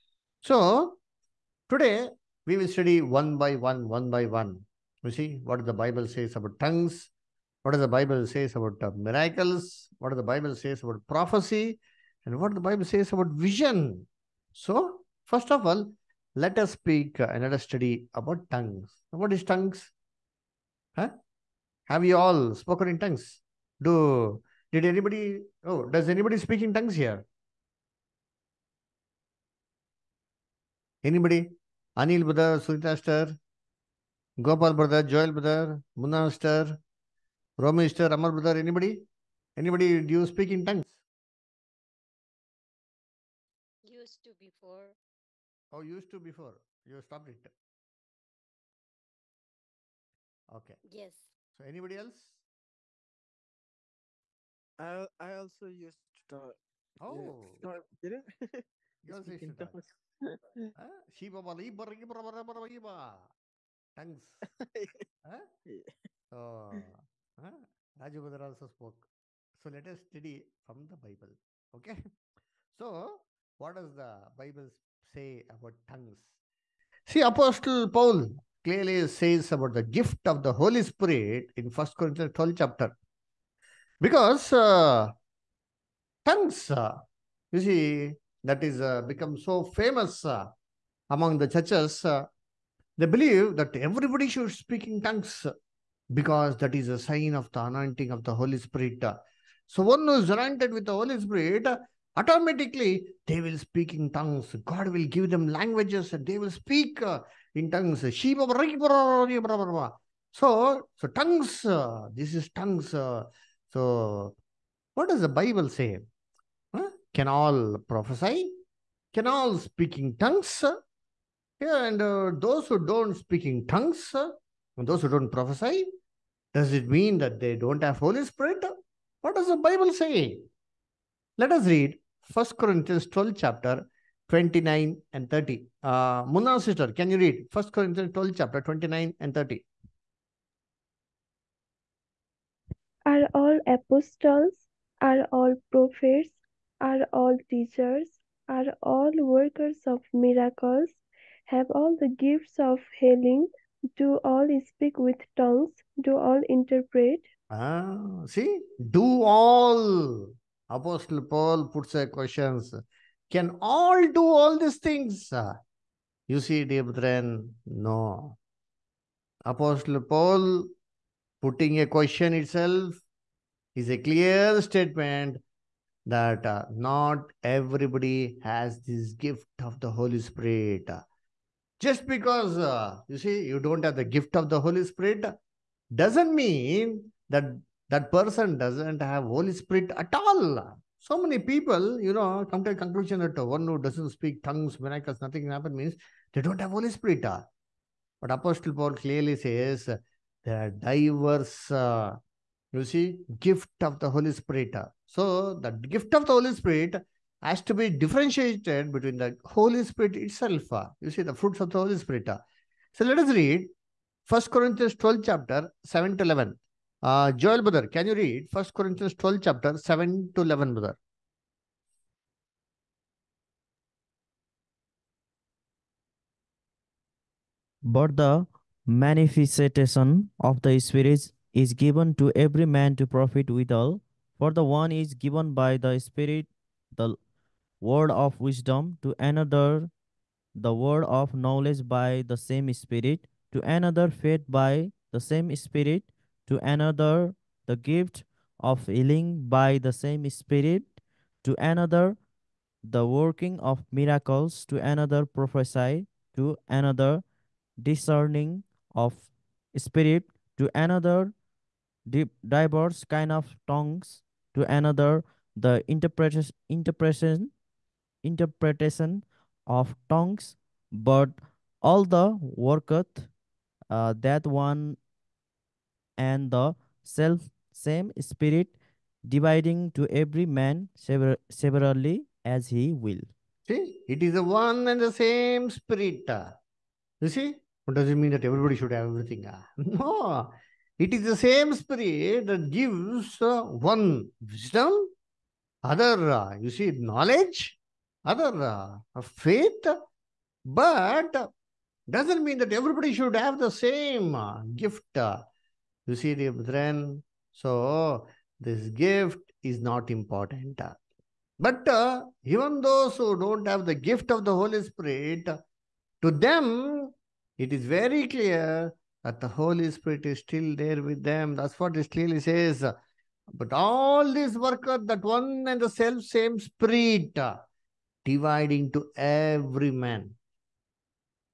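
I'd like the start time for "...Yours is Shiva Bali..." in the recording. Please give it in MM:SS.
00:59.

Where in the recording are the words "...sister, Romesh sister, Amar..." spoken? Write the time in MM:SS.
00:36.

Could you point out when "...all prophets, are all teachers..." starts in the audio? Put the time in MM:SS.
02:25.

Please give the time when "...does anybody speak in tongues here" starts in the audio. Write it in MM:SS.
00:25.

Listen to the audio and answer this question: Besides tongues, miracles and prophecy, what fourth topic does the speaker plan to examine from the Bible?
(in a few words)
Vision.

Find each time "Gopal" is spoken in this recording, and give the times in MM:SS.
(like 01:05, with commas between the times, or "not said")
00:34.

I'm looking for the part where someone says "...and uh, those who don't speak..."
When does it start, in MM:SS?
02:01.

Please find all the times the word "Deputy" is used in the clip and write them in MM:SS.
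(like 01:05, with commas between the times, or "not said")
not said.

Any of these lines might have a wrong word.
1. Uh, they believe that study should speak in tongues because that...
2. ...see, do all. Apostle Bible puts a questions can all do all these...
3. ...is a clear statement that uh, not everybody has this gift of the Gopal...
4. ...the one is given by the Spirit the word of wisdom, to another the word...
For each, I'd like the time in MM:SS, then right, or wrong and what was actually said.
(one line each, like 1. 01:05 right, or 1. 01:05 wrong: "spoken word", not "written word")
1. 01:32 wrong: "everybody", not "study"
2. 02:38 wrong: "Paul", not "Bible"
3. 02:53 wrong: "Holy", not "Gopal"
4. 03:54 right.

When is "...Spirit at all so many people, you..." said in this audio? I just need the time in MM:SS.
03:09.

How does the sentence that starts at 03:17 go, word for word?
But Apostle Paul clearly says there are diverse, uh, you see, gift of the Holy Spirit.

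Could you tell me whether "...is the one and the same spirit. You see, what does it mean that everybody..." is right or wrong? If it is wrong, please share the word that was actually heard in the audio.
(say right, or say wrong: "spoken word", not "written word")
right.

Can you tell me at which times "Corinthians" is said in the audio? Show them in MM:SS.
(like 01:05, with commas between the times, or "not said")
01:21, 02:12, 02:17, 03:34, 03:38.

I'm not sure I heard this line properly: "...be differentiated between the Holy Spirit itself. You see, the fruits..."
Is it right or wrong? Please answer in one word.
right.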